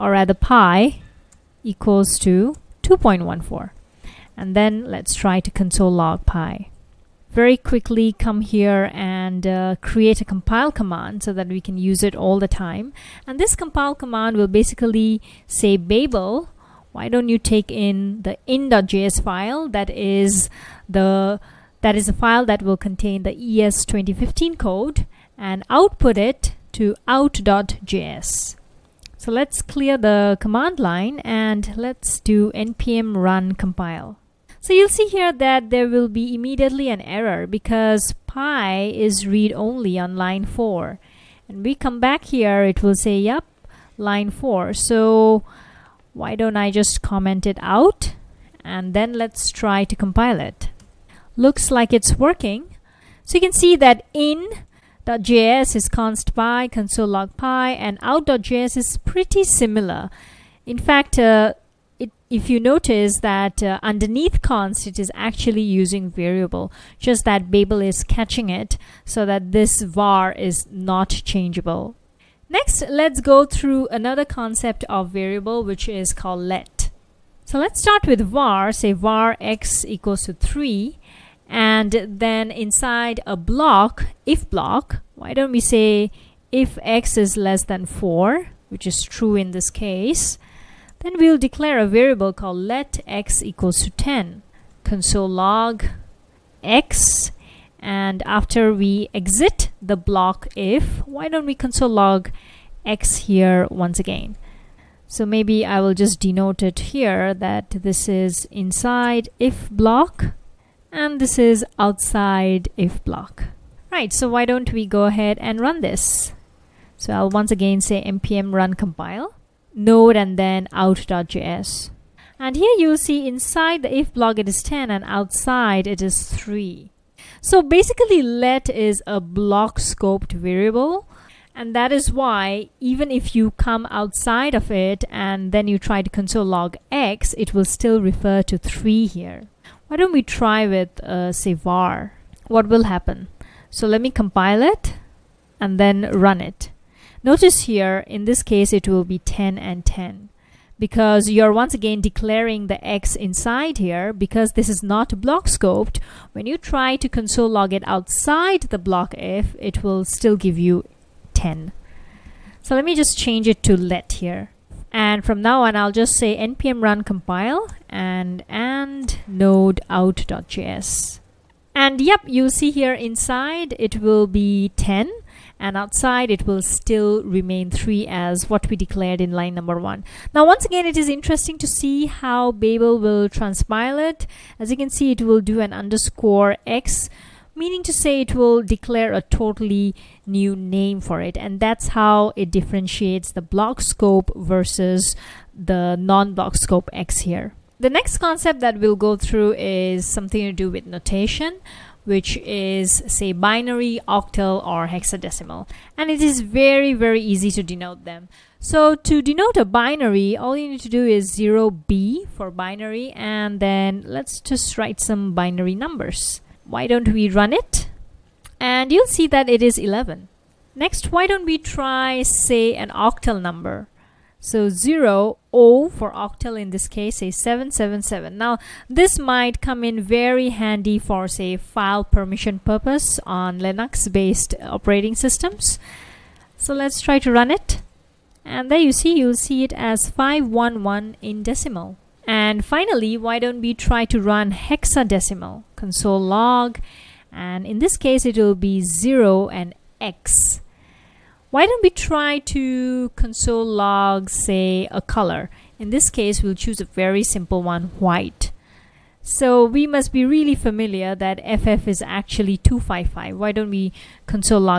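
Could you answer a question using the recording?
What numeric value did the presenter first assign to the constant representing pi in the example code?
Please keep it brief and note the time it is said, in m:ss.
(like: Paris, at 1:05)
2.14, at 0:02.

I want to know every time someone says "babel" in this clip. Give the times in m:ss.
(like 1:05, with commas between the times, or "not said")
0:15, 1:07, 3:02.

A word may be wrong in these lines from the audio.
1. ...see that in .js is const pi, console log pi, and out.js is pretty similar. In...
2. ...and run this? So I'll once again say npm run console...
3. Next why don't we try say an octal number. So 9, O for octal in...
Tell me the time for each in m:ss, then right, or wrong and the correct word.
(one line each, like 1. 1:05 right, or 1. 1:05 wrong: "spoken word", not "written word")
1. 0:53 right
2. 1:55 wrong: "compile", not "console"
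3. 3:40 wrong: "0", not "9".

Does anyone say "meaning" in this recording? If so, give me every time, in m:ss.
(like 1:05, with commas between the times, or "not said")
3:07.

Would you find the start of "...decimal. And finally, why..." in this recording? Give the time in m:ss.
4:01.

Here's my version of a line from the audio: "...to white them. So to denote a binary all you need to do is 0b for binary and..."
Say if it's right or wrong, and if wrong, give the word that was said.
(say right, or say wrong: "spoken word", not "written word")
wrong: "denote", not "white".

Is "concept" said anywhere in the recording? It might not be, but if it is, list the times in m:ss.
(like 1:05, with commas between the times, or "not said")
1:14, 3:18.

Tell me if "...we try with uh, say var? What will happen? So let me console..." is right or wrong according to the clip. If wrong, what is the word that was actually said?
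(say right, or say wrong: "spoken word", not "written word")
wrong: "compile", not "console".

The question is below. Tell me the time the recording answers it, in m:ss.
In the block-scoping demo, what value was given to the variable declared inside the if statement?
1:32.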